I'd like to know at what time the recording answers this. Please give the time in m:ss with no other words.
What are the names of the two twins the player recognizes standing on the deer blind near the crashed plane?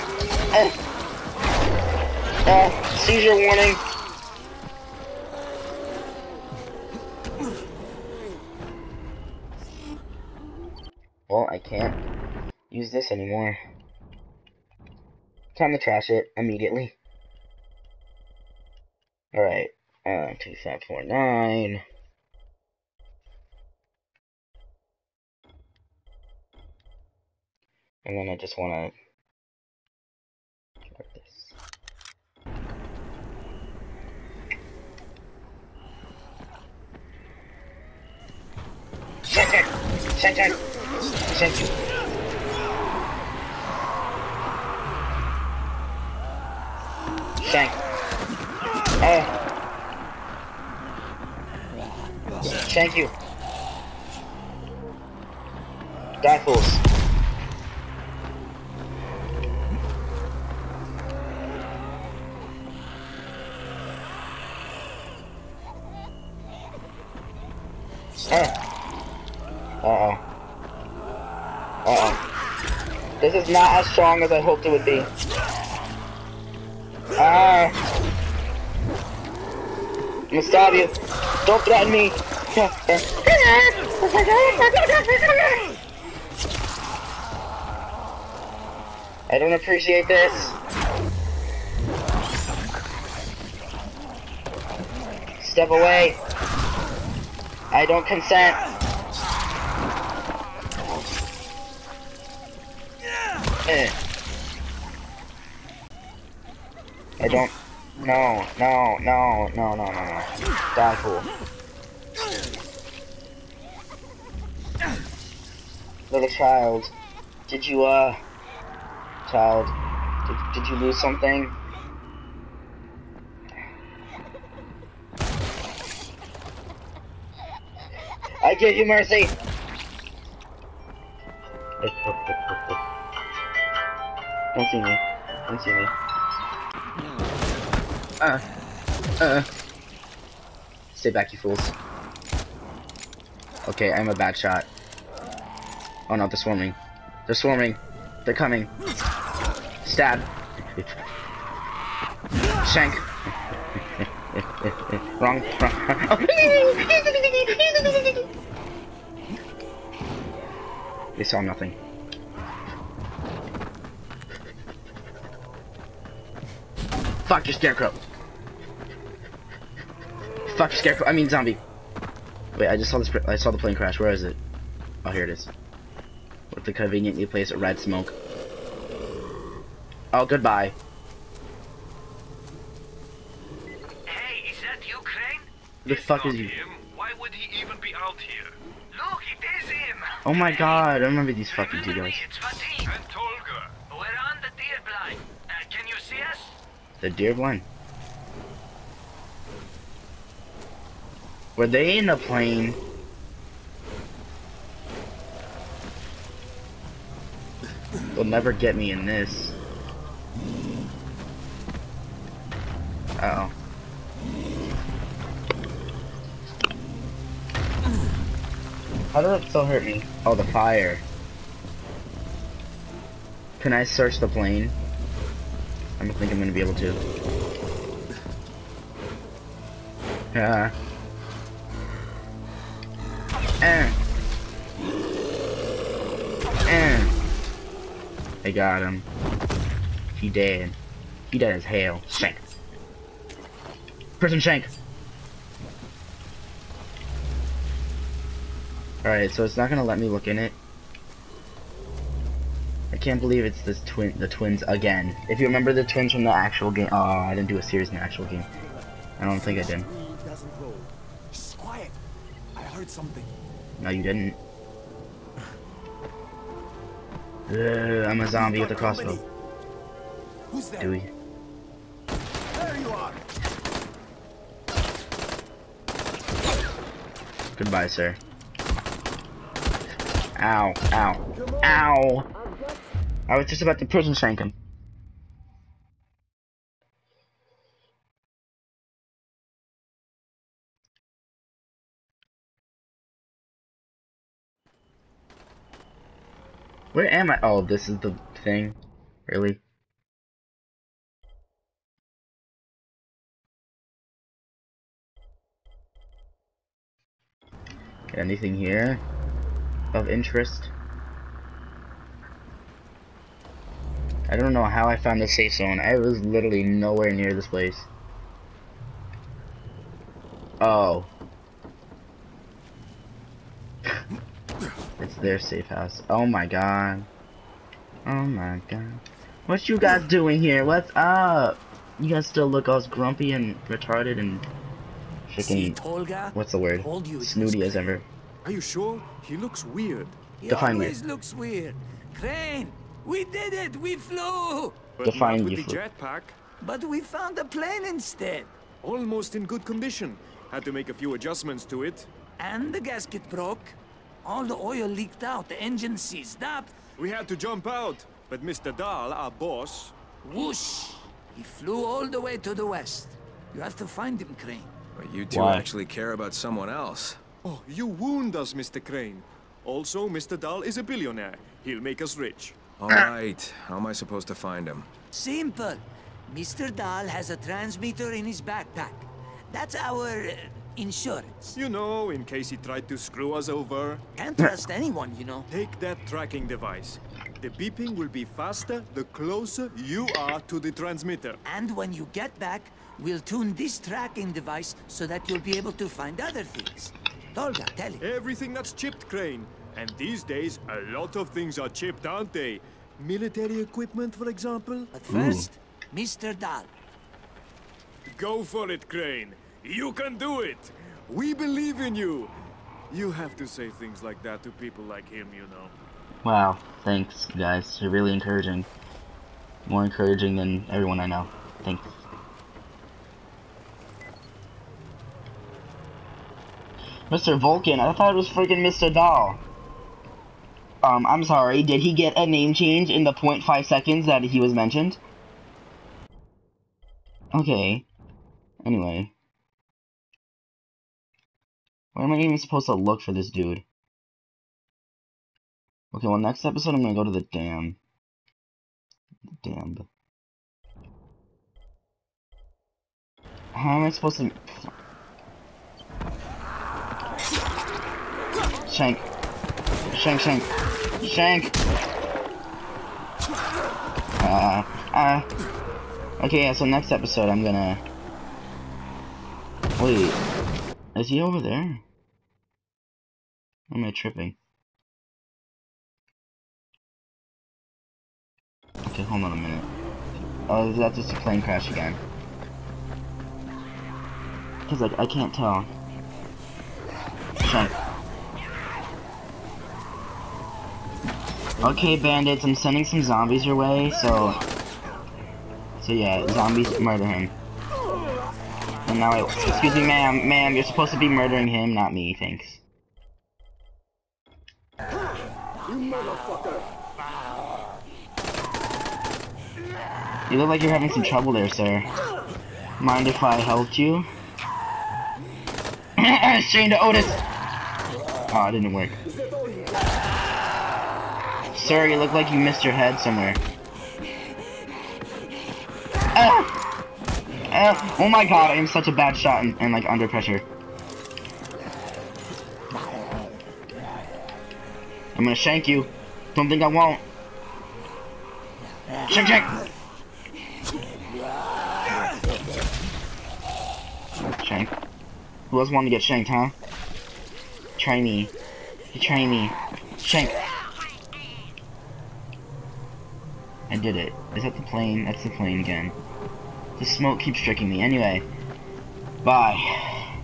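3:12.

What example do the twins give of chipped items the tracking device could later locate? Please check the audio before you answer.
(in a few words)
Military equipment.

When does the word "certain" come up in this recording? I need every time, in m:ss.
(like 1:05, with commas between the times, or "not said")
not said.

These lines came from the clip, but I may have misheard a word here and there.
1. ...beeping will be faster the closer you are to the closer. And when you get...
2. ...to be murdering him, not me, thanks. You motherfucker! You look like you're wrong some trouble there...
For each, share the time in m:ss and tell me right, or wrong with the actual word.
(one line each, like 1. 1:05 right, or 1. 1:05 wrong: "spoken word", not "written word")
1. 6:27 wrong: "transmitter", not "closer"
2. 8:20 wrong: "having", not "wrong".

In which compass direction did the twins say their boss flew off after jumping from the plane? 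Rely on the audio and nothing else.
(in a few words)
west.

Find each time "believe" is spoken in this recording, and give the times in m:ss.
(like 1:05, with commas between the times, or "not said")
4:13, 6:51.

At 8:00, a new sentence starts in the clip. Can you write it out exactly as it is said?
Oh, is that just a plane crash again.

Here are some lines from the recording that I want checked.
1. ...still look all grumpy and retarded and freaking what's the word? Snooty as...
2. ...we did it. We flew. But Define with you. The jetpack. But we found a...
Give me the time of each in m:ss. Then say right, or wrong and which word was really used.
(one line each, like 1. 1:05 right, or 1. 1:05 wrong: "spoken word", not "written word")
1. 5:32 right
2. 5:43 right.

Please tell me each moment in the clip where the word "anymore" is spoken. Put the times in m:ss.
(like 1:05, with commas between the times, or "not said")
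0:13.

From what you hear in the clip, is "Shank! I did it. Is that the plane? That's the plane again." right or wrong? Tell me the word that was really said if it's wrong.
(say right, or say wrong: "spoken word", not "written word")
right.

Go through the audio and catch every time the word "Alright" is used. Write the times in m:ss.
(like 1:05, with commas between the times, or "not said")
0:19, 4:09.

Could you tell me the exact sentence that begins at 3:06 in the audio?
Why would he even be out here?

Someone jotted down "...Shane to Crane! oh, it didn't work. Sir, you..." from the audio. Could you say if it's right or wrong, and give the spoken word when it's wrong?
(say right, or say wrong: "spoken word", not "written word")
wrong: "Otis", not "Crane".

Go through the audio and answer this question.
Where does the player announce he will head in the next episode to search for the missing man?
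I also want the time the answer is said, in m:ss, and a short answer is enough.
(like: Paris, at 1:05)
the dam, at 7:27.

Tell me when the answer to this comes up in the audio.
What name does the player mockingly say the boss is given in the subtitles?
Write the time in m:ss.
7:07.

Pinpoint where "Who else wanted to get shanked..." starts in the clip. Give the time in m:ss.
9:05.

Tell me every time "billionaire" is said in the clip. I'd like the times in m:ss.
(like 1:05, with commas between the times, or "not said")
6:10.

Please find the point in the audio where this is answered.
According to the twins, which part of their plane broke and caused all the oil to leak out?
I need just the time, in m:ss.
5:52.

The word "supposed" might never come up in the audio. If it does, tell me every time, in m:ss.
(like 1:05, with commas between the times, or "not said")
6:13, 7:22, 7:33, 8:20.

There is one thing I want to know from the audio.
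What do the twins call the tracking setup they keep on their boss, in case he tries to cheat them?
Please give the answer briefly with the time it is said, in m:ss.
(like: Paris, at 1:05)
Insurance, at 6:20.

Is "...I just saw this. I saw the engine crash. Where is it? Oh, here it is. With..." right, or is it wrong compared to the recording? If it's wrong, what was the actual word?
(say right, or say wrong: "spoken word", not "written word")
wrong: "plane", not "engine".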